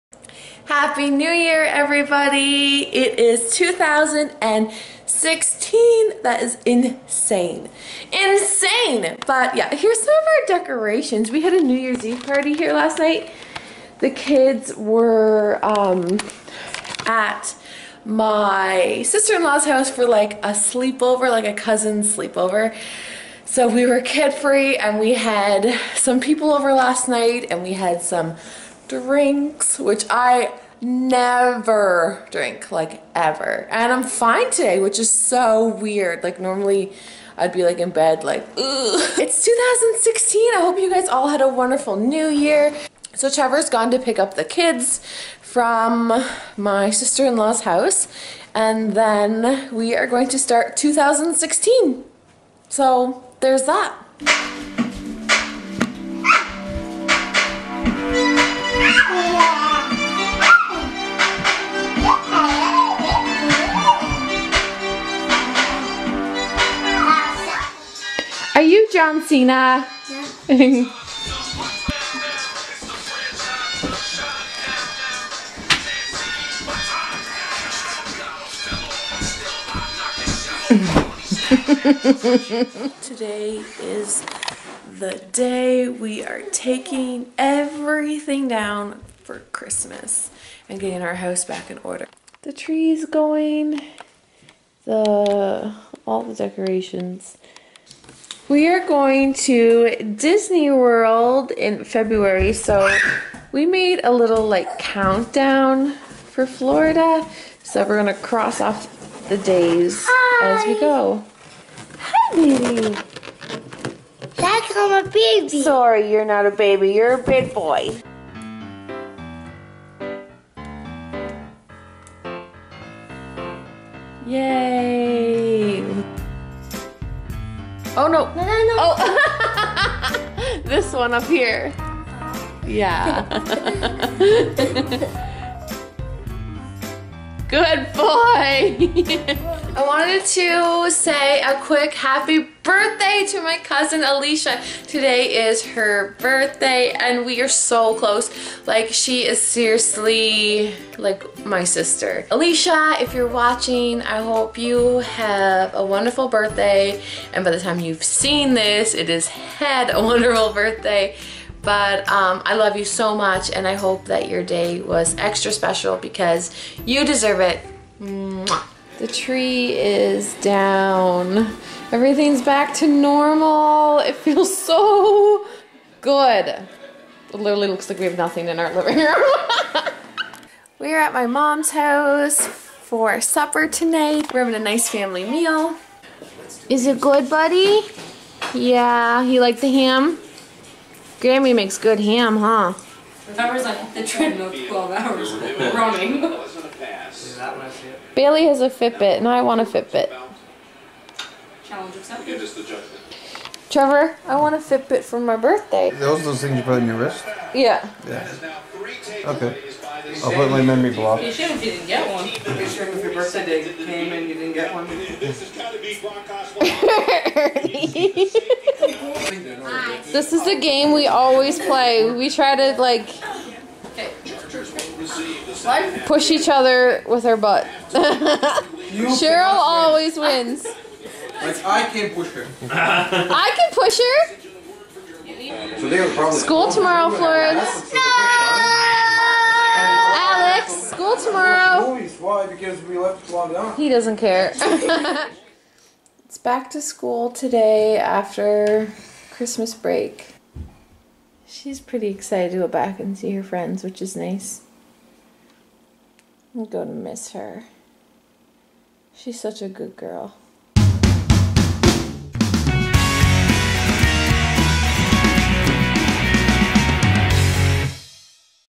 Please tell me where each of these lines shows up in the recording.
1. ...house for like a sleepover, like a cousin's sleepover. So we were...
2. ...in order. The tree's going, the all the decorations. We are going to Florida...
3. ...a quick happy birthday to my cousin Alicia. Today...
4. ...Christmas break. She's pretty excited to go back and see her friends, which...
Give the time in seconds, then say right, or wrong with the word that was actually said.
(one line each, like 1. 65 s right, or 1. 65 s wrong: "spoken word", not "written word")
1. 19 s right
2. 91 s wrong: "Disney", not "Florida"
3. 141 s right
4. 249 s right.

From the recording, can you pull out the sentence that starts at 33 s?
And I'm fine today, which is so weird.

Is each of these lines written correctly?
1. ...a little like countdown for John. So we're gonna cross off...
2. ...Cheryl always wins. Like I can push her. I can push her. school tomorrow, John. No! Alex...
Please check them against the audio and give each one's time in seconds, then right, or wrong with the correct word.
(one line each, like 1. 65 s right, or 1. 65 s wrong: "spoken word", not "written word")
1. 104 s wrong: "Florida", not "John"
2. 227 s wrong: "Florence", not "John".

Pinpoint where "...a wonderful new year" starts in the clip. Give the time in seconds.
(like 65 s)
41 s.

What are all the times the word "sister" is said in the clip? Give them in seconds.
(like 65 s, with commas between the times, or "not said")
19 s, 46 s, 151 s.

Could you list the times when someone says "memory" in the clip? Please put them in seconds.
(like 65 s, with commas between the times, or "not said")
210 s.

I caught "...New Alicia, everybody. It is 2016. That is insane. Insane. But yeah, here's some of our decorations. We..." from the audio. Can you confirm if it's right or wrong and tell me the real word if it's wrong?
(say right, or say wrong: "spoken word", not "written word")
wrong: "Year", not "Alicia".